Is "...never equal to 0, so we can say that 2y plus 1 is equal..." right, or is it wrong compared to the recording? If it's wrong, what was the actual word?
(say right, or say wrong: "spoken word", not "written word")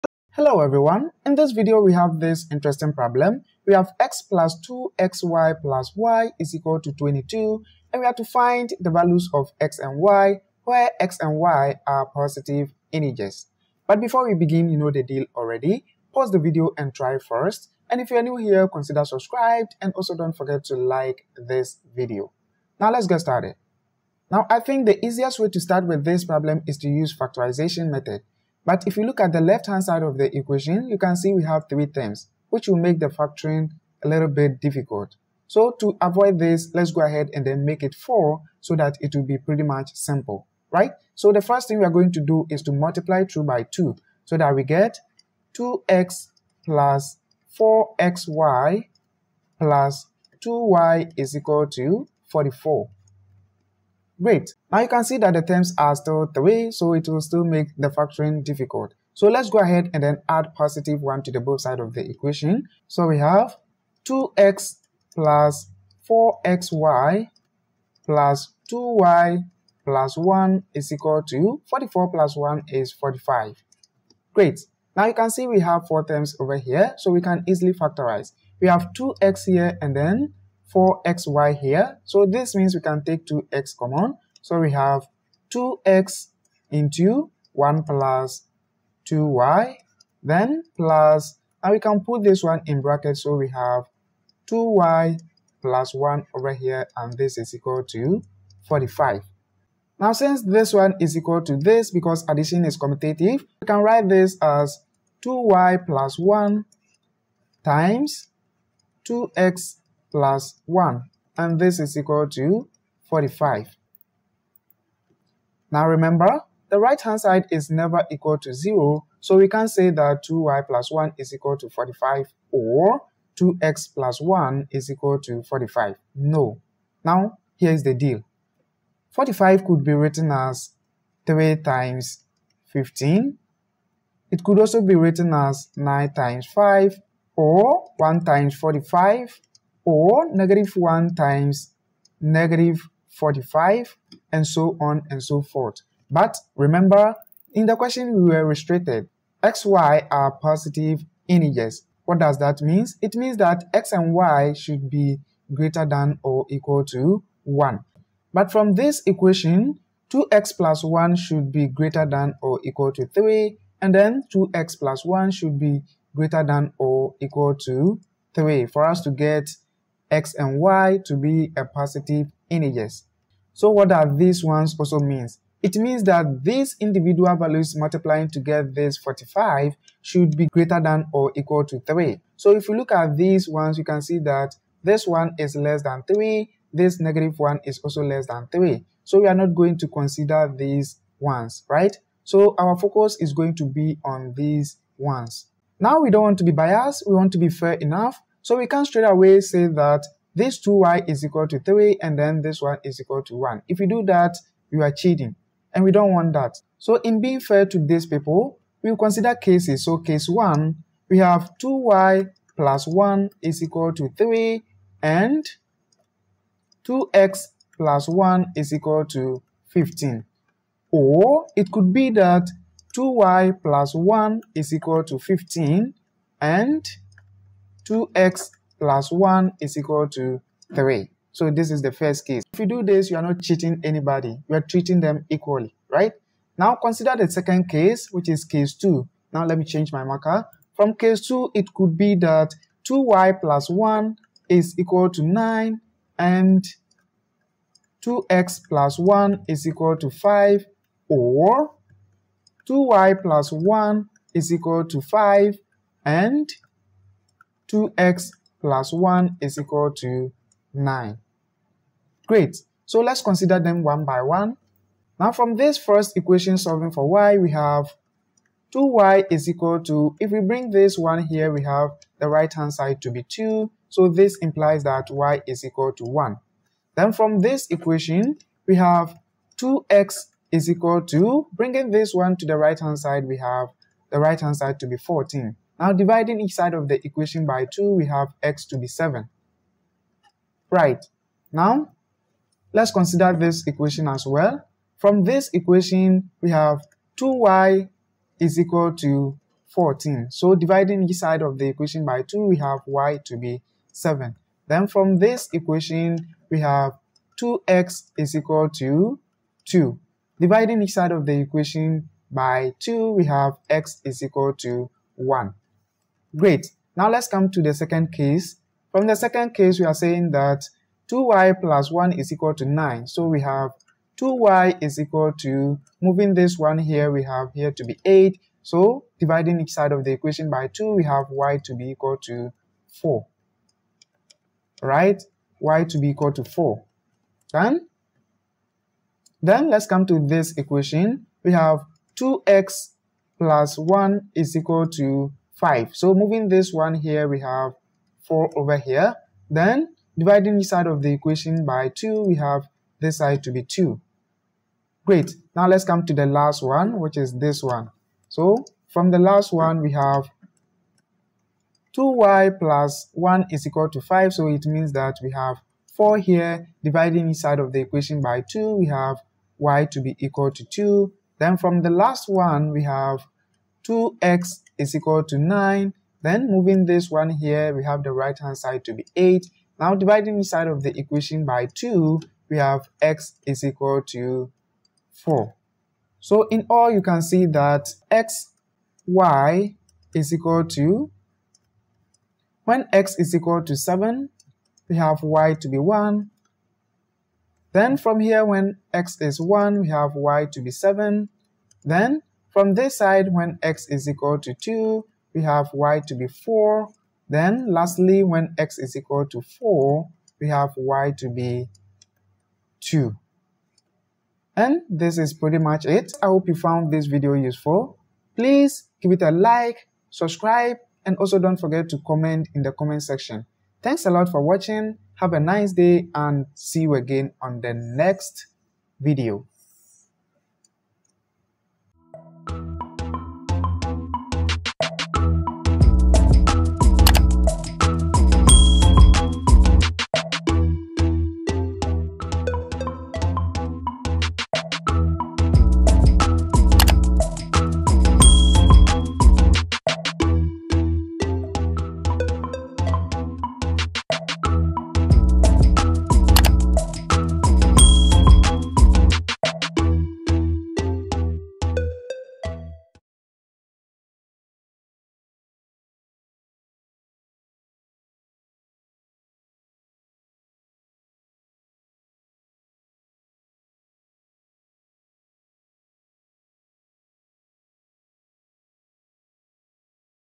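right.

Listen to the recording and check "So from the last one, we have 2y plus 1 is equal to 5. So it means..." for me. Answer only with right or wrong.
right.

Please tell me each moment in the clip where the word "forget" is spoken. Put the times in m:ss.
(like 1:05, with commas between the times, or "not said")
0:20, 7:01.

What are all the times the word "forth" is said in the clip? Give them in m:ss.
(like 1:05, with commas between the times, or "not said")
2:25.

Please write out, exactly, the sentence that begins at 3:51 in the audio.
So this is the first case.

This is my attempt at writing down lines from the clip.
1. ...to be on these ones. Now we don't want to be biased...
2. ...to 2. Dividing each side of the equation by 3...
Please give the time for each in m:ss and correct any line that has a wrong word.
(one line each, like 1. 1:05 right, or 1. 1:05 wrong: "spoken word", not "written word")
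1. 3:13 right
2. 5:08 wrong: "2", not "3".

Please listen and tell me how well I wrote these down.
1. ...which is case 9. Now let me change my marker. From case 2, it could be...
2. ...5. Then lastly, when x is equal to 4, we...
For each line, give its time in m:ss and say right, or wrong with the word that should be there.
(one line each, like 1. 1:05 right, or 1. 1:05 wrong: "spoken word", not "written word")
1. 3:58 wrong: "2", not "9"
2. 6:46 wrong: "4", not "5".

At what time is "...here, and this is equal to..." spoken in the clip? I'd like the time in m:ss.
1:36.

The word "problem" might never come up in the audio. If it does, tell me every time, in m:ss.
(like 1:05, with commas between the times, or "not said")
0:02, 0:26.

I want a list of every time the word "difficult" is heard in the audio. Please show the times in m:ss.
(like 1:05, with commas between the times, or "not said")
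0:34, 0:58.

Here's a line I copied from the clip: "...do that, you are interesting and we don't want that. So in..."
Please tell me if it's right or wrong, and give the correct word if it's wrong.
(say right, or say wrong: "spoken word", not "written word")
wrong: "cheating", not "interesting".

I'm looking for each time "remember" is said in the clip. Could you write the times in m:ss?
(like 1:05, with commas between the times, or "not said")
1:55, 2:26.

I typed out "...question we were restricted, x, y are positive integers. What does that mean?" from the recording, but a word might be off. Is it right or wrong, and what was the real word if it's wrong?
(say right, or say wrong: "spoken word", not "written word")
right.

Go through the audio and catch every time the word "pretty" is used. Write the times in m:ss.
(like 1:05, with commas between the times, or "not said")
0:39, 6:55.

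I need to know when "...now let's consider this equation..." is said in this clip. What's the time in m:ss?
4:51.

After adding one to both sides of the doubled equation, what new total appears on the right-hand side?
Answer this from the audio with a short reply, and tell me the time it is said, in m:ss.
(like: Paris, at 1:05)
45, at 1:11.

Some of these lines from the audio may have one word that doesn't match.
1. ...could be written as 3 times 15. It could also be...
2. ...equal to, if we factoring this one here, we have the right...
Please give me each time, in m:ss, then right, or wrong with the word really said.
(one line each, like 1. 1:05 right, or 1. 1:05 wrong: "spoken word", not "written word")
1. 2:09 right
2. 4:29 wrong: "bring", not "factoring".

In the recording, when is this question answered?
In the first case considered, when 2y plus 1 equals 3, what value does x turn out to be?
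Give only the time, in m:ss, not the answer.
4:47.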